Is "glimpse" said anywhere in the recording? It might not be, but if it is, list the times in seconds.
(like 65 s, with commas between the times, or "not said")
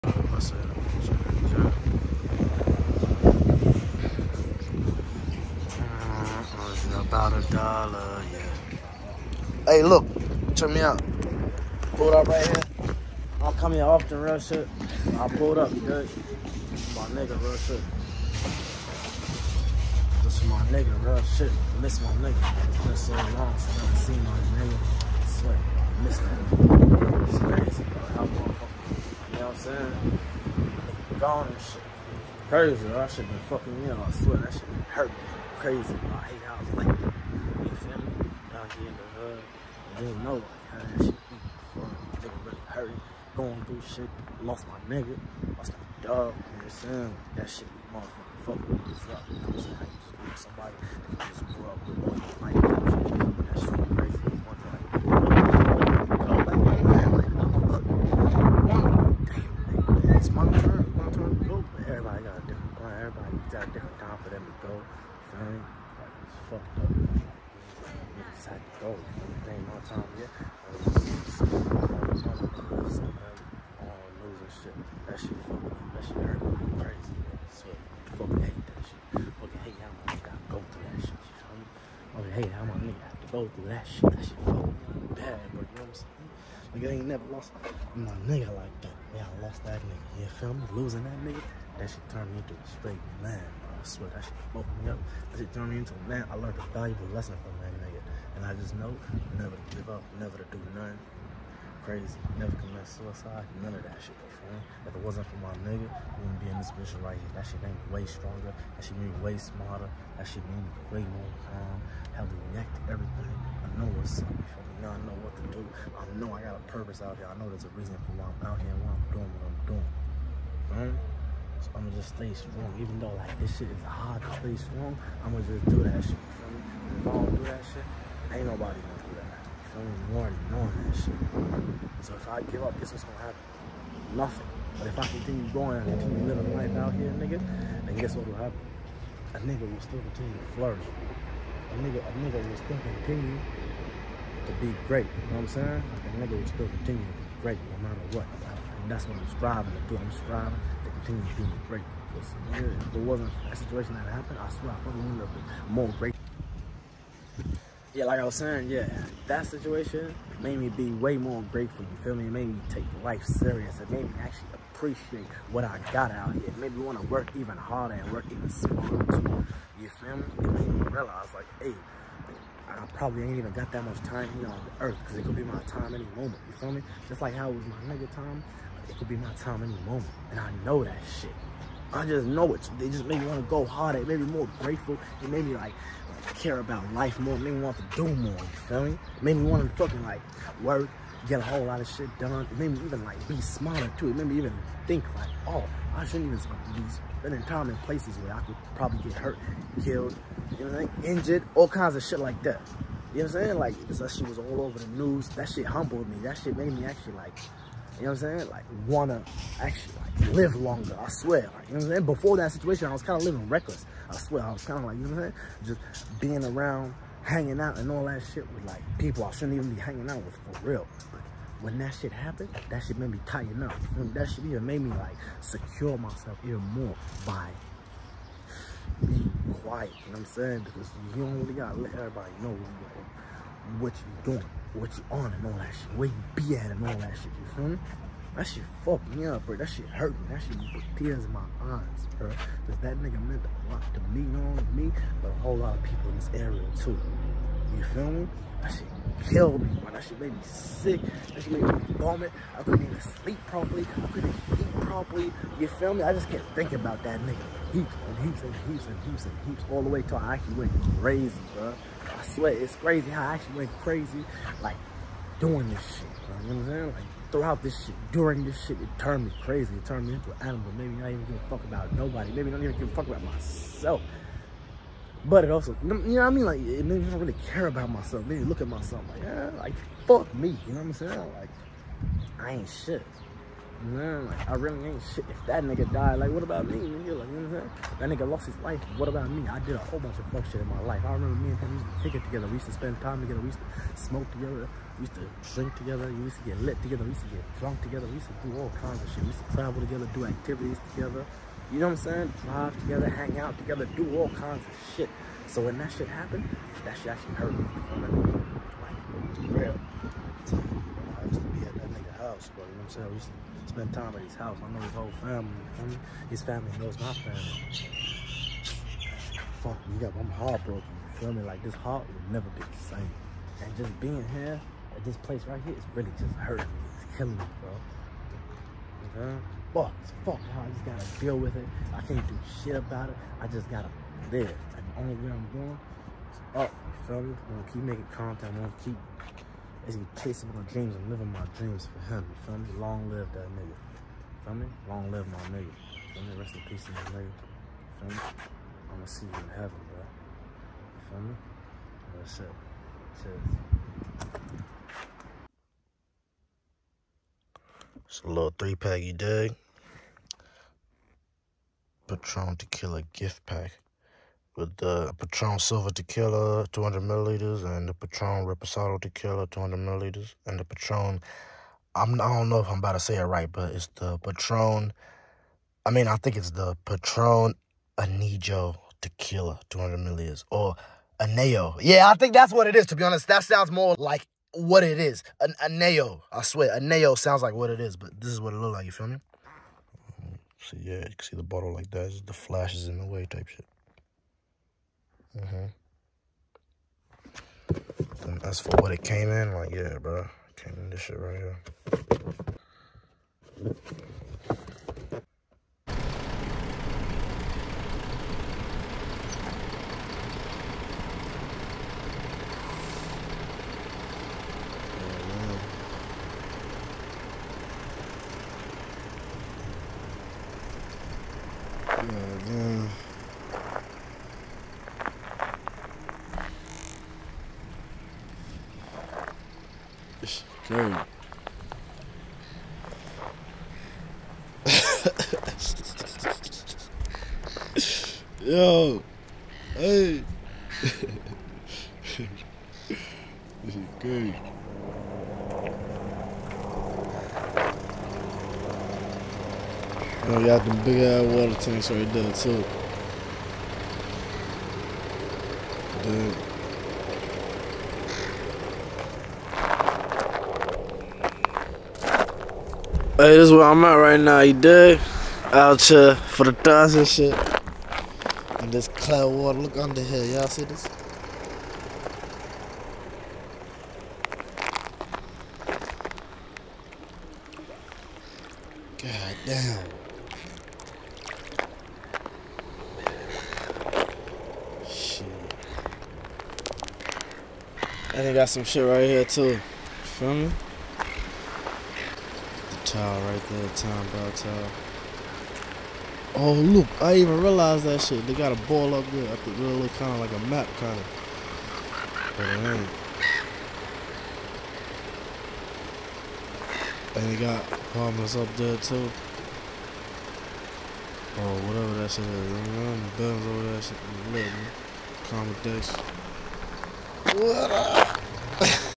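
not said.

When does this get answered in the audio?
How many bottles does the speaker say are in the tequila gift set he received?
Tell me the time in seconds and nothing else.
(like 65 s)
358 s.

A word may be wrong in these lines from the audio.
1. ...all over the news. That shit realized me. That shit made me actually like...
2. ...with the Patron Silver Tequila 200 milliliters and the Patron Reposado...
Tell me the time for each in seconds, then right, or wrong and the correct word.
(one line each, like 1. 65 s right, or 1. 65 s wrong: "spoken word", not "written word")
1. 204 s wrong: "humbled", not "realized"
2. 364 s right.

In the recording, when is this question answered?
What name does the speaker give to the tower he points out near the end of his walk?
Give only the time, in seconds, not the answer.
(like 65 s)
493 s.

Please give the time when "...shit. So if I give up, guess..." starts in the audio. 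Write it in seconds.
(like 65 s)
130 s.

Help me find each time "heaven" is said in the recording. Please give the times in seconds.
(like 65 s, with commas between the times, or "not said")
349 s.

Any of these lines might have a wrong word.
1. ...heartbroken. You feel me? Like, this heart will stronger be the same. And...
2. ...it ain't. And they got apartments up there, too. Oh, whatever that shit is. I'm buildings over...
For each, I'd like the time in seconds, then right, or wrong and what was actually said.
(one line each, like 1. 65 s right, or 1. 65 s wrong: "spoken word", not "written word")
1. 320 s wrong: "never", not "stronger"
2. 502 s right.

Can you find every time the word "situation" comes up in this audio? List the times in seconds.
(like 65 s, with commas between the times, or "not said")
153 s, 159 s, 212 s.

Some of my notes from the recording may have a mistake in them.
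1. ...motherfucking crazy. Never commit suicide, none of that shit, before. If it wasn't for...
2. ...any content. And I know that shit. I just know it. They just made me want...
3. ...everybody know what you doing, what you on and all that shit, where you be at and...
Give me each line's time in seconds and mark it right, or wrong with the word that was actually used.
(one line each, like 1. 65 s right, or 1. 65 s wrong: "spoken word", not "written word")
1. 100 s wrong: "nothing", not "motherfucking"
2. 179 s wrong: "moment", not "content"
3. 231 s right.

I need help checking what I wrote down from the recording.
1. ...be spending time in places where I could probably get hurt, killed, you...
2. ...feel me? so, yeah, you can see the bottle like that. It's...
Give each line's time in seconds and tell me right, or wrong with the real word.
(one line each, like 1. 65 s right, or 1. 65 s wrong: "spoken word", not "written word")
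1. 196 s right
2. 388 s right.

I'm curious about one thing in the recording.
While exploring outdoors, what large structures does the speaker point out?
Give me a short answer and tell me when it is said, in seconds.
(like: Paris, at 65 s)
Water tanks, at 451 s.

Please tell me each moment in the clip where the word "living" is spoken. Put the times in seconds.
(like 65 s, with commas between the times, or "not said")
136 s, 213 s, 341 s.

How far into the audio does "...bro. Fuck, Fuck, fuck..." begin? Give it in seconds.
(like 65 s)
327 s.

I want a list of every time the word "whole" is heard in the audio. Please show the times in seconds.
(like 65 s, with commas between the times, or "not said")
191 s, 245 s, 289 s, 314 s.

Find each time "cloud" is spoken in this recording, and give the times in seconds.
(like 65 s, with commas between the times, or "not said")
468 s.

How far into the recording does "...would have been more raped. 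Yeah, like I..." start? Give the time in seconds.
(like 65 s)
155 s.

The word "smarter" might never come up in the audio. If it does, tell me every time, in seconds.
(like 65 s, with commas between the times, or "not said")
109 s, 168 s, 193 s.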